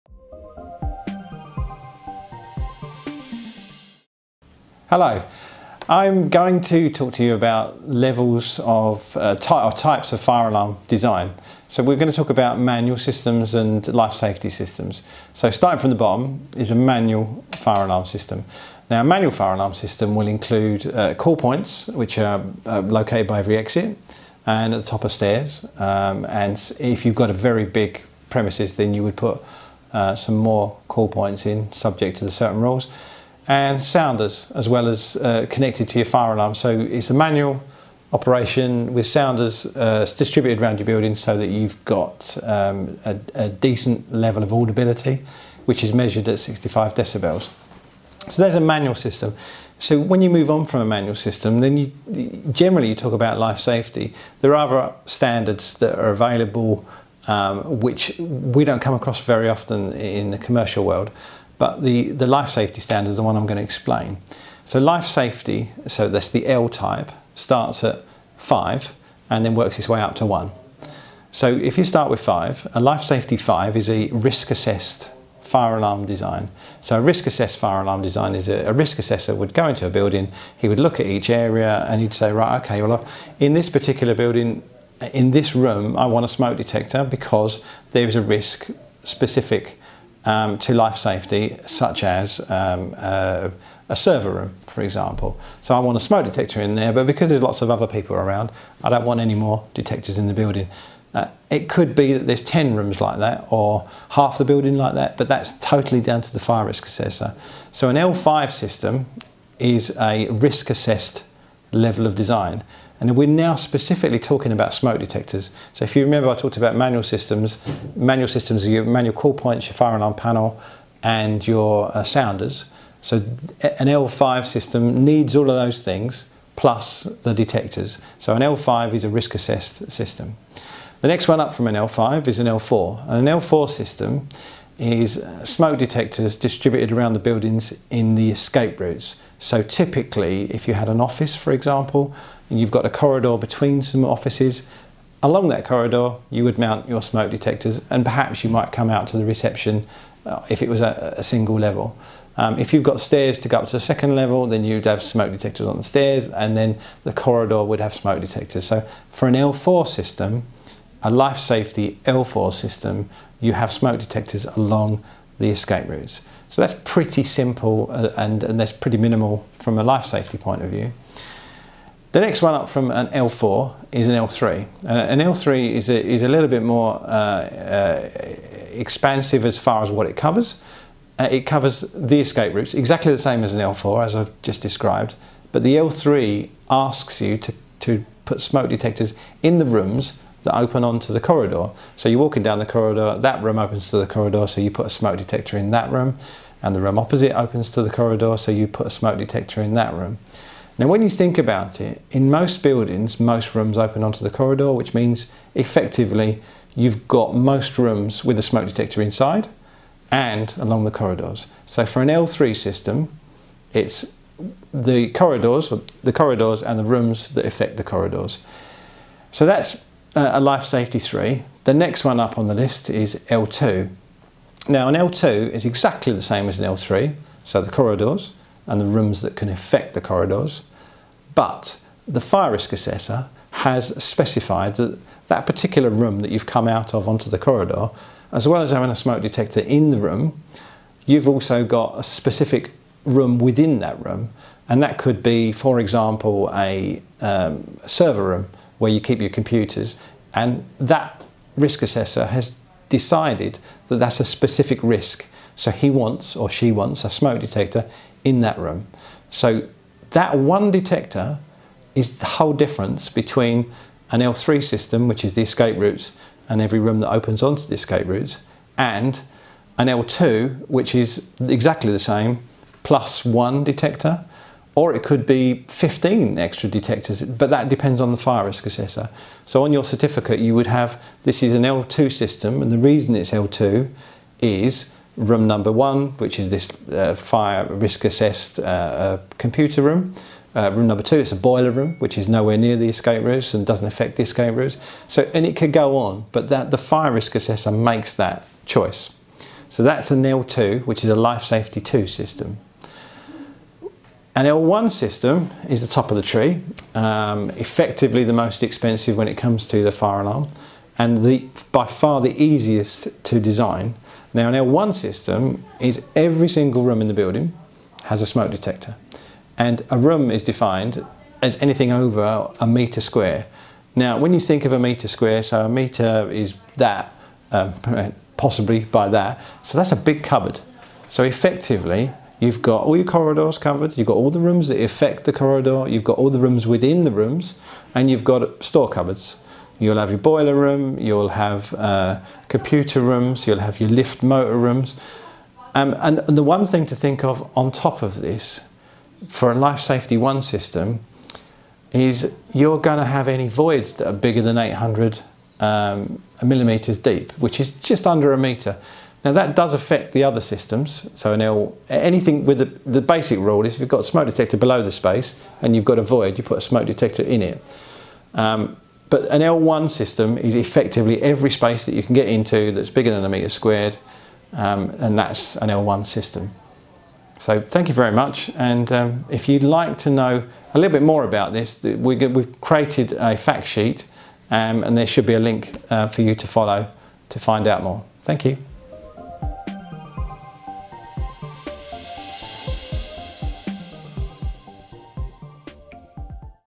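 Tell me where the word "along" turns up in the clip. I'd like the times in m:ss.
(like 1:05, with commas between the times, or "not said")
2:25, 2:44, 3:30.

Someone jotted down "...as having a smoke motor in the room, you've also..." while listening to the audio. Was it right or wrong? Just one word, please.
wrong.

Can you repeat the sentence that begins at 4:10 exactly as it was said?
And that risk assessor has decided that that's a specific risk.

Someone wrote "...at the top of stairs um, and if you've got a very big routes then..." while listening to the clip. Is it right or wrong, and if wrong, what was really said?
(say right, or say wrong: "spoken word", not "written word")
wrong: "premises", not "routes".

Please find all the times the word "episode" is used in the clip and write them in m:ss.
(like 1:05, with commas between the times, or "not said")
not said.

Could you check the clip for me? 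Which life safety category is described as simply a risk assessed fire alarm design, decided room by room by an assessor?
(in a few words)
L5.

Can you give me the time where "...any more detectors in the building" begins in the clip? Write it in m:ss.
1:39.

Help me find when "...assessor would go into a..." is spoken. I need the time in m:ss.
1:18.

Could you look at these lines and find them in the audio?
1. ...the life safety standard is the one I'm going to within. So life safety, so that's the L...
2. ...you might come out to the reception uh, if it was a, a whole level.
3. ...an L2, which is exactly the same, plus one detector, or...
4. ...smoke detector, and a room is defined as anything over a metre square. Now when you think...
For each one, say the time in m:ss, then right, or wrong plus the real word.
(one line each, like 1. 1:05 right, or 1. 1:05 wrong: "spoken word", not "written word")
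1. 1:02 wrong: "explain", not "within"
2. 2:28 wrong: "single", not "whole"
3. 4:29 right
4. 5:18 right.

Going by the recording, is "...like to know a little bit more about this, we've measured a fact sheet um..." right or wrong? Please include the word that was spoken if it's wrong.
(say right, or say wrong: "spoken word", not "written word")
wrong: "created", not "measured".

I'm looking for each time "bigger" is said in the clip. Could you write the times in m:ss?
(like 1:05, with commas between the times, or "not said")
5:54, 6:12.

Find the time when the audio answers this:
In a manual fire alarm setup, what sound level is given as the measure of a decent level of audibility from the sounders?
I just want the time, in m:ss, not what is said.
0:46.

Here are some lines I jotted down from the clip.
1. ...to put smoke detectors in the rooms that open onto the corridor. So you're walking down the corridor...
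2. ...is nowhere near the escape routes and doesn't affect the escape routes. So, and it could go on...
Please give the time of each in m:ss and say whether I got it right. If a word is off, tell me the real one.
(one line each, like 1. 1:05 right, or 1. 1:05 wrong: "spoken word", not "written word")
1. 3:07 right
2. 4:52 right.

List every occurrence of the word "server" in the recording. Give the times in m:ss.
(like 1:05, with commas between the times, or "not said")
1:33, 4:07.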